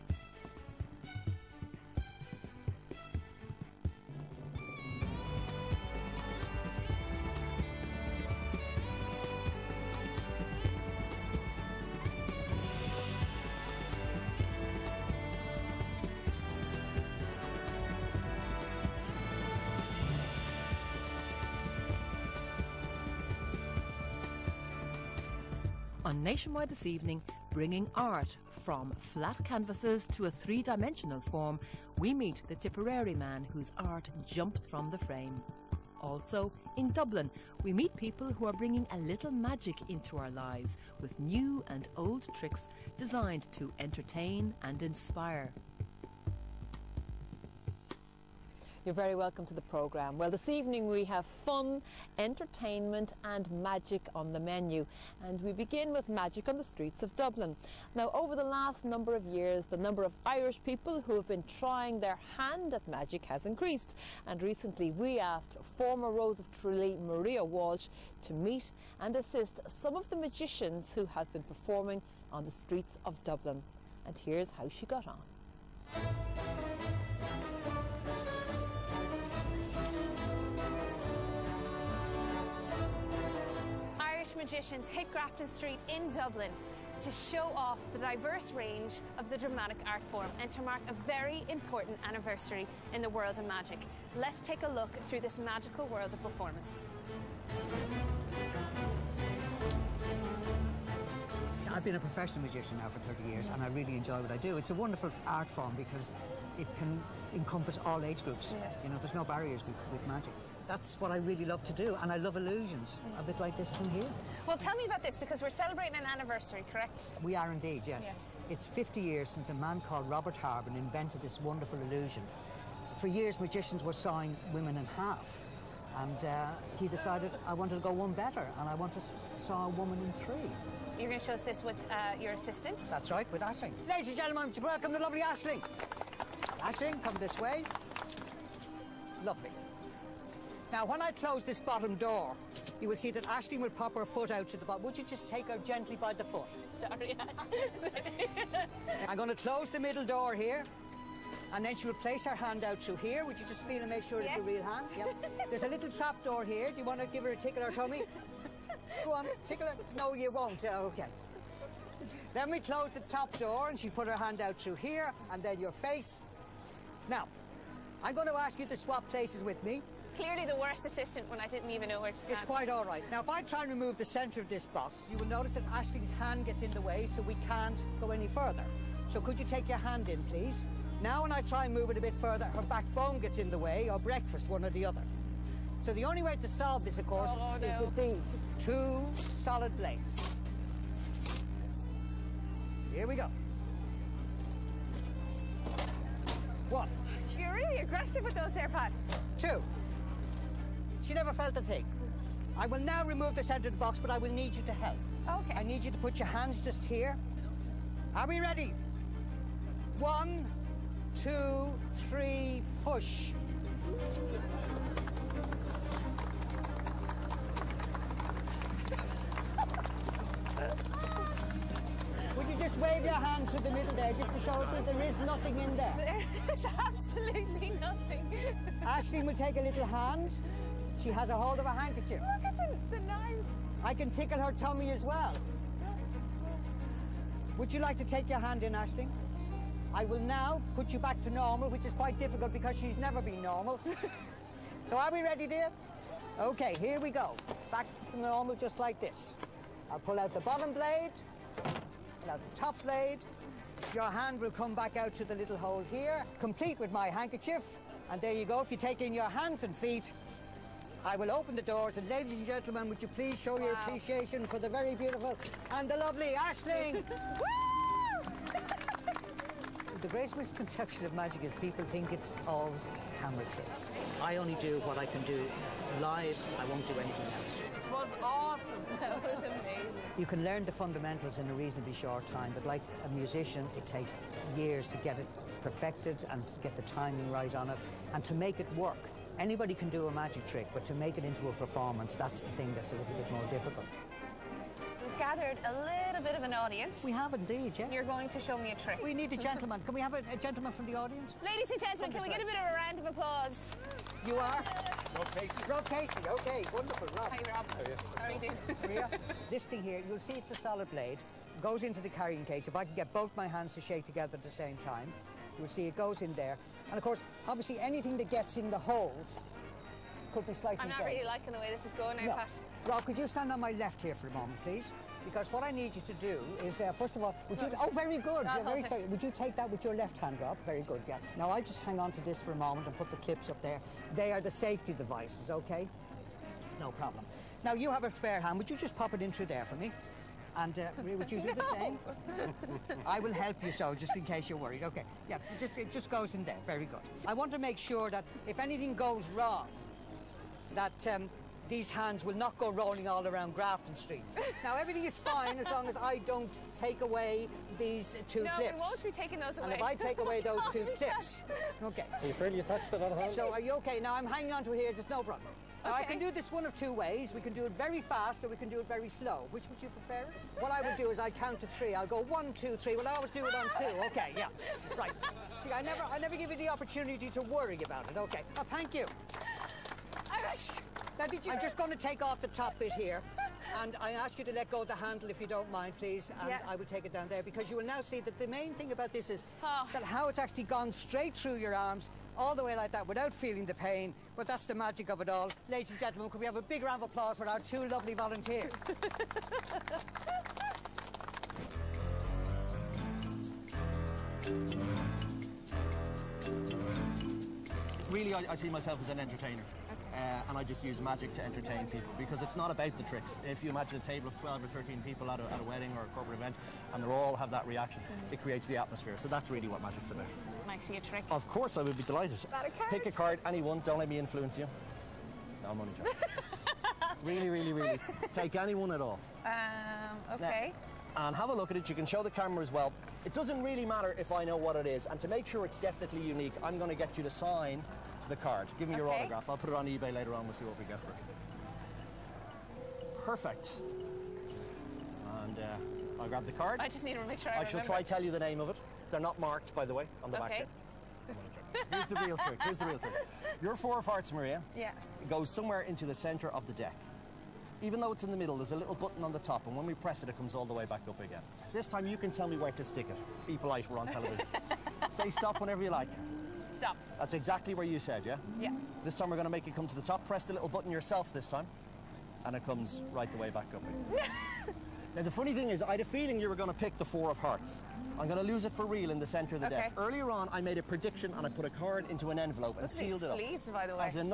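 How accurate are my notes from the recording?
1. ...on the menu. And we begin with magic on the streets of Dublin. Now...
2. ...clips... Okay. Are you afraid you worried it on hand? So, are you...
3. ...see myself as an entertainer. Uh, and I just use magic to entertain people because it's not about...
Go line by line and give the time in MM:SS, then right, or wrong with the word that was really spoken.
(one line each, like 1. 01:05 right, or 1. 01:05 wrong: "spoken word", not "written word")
1. 00:54 right
2. 06:00 wrong: "touched", not "worried"
3. 06:48 right.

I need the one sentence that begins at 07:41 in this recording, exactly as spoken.
This time you can tell me where to stick it.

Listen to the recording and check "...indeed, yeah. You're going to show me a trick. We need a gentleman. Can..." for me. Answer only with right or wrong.
right.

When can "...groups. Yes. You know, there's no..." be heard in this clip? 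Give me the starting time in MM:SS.
01:48.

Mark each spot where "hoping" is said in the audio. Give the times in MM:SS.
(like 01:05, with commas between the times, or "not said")
not said.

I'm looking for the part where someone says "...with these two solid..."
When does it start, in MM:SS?
03:07.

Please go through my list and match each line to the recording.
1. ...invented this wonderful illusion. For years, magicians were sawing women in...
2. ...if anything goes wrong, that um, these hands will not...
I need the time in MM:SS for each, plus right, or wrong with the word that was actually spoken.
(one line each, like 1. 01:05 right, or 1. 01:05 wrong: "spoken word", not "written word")
1. 02:00 right
2. 05:48 right.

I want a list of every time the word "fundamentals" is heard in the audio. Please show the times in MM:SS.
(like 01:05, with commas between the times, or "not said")
04:40.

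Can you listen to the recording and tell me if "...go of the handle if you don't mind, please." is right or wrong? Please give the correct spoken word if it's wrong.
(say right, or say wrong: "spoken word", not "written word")
right.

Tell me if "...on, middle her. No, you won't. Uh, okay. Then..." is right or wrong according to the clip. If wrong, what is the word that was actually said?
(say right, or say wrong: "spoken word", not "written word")
wrong: "tickle", not "middle".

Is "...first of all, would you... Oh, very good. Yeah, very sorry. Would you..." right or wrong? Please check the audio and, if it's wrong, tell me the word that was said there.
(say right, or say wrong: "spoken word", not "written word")
right.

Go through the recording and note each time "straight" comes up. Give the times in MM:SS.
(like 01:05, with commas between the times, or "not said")
06:30.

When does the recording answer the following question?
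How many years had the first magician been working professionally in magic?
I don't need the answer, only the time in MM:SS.
01:43.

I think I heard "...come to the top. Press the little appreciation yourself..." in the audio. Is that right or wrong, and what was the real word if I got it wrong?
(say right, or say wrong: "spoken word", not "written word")
wrong: "button", not "appreciation".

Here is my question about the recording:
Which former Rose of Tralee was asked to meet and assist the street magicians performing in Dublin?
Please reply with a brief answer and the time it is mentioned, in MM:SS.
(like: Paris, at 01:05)
Maria Walsh, at 01:07.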